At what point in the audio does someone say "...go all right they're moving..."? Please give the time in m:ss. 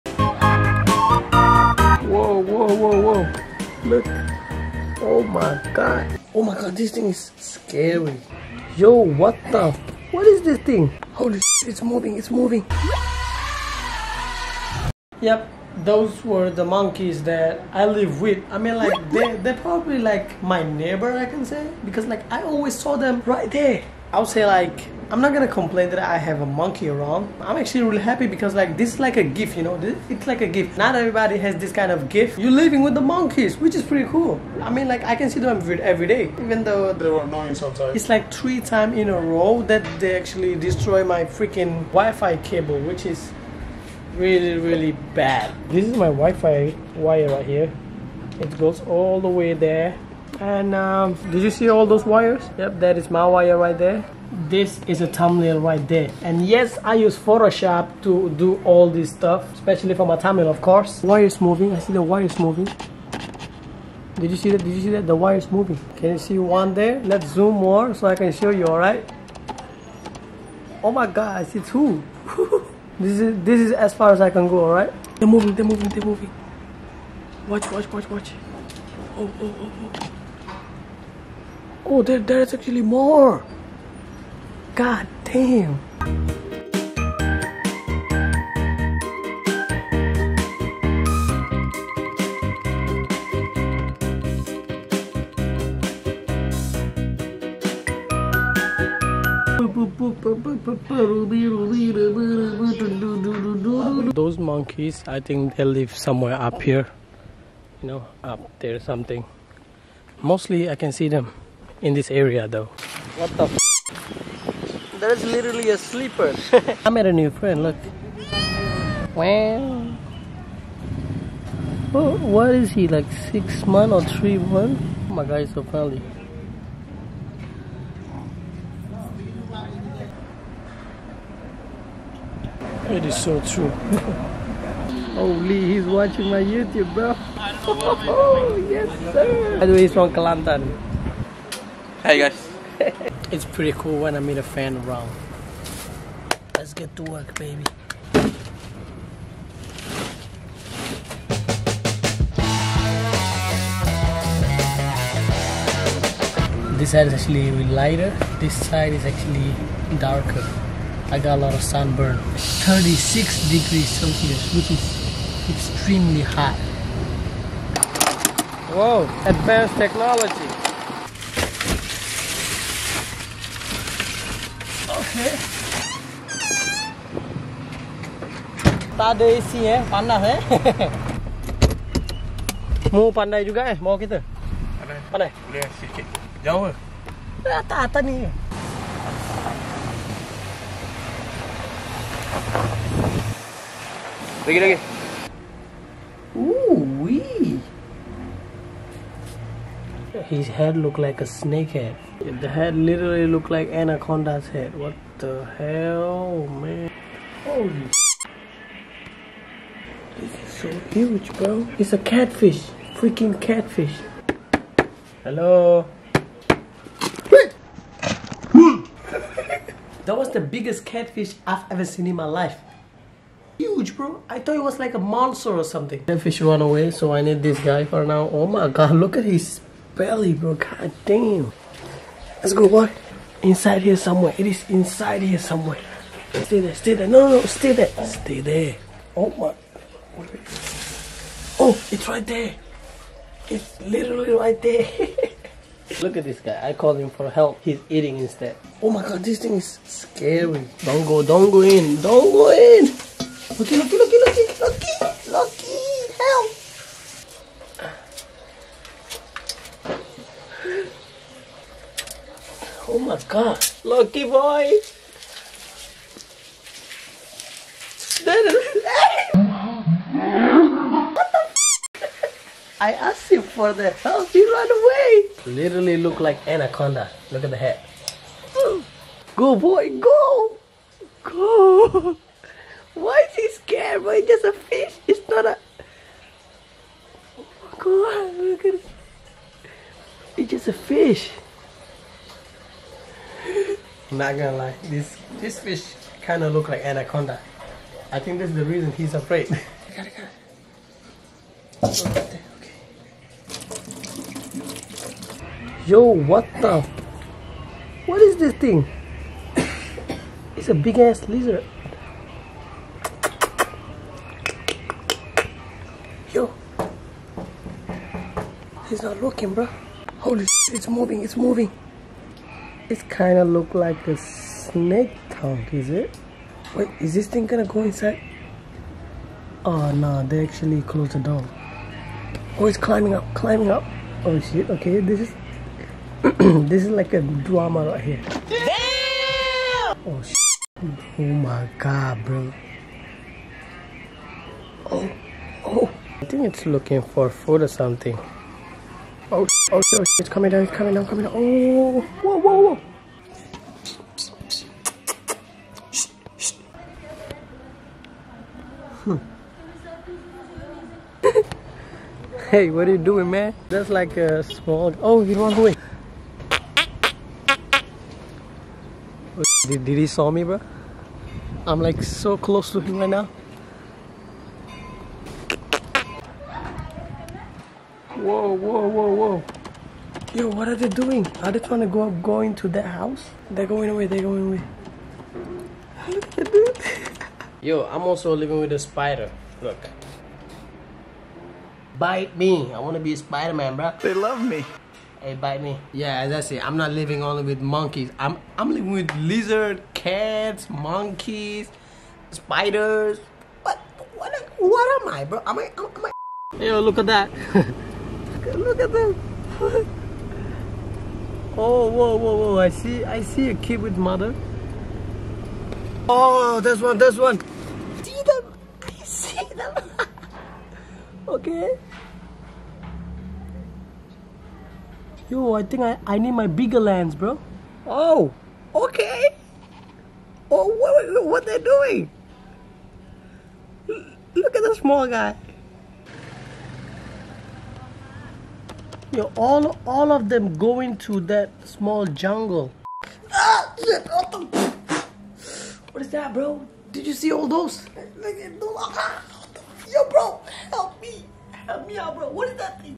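1:14.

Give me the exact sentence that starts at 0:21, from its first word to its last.
Because, like, I always saw them right there.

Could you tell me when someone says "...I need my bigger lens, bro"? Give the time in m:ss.
7:06.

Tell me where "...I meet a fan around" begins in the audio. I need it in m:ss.
2:24.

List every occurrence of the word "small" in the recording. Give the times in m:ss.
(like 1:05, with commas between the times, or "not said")
6:04, 7:14, 7:21.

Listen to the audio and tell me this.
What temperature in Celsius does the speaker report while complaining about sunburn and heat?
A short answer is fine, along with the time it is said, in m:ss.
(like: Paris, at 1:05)
36 degrees, at 2:42.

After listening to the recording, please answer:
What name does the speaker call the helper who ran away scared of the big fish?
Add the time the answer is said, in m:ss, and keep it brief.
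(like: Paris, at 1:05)
Loki, at 4:23.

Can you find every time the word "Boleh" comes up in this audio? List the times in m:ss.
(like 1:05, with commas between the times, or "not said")
3:05.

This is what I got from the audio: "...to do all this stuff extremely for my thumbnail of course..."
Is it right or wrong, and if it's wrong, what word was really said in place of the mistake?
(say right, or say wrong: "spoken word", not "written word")
wrong: "especially", not "extremely".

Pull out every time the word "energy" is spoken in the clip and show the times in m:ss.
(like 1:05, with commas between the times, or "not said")
not said.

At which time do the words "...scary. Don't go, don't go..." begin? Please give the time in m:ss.
4:09.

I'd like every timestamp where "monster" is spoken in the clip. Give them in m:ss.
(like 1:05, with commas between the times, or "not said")
3:44.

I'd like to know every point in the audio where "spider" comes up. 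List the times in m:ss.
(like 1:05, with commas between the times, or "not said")
6:28, 6:33, 6:42.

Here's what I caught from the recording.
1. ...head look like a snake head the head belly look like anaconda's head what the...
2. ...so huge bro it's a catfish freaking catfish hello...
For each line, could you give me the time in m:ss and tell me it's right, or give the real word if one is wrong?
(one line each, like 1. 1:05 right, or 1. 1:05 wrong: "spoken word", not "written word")
1. 3:20 wrong: "literally", not "belly"
2. 3:30 right.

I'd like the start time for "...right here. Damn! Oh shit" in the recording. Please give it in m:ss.
5:37.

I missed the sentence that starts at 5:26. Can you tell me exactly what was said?
Wait, is this thing gonna go inside?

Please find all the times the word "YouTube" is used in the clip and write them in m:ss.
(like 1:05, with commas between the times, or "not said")
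2:16.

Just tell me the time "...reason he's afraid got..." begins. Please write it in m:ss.
4:58.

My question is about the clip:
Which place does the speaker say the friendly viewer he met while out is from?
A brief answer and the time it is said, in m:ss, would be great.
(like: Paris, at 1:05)
Kelantan, at 2:20.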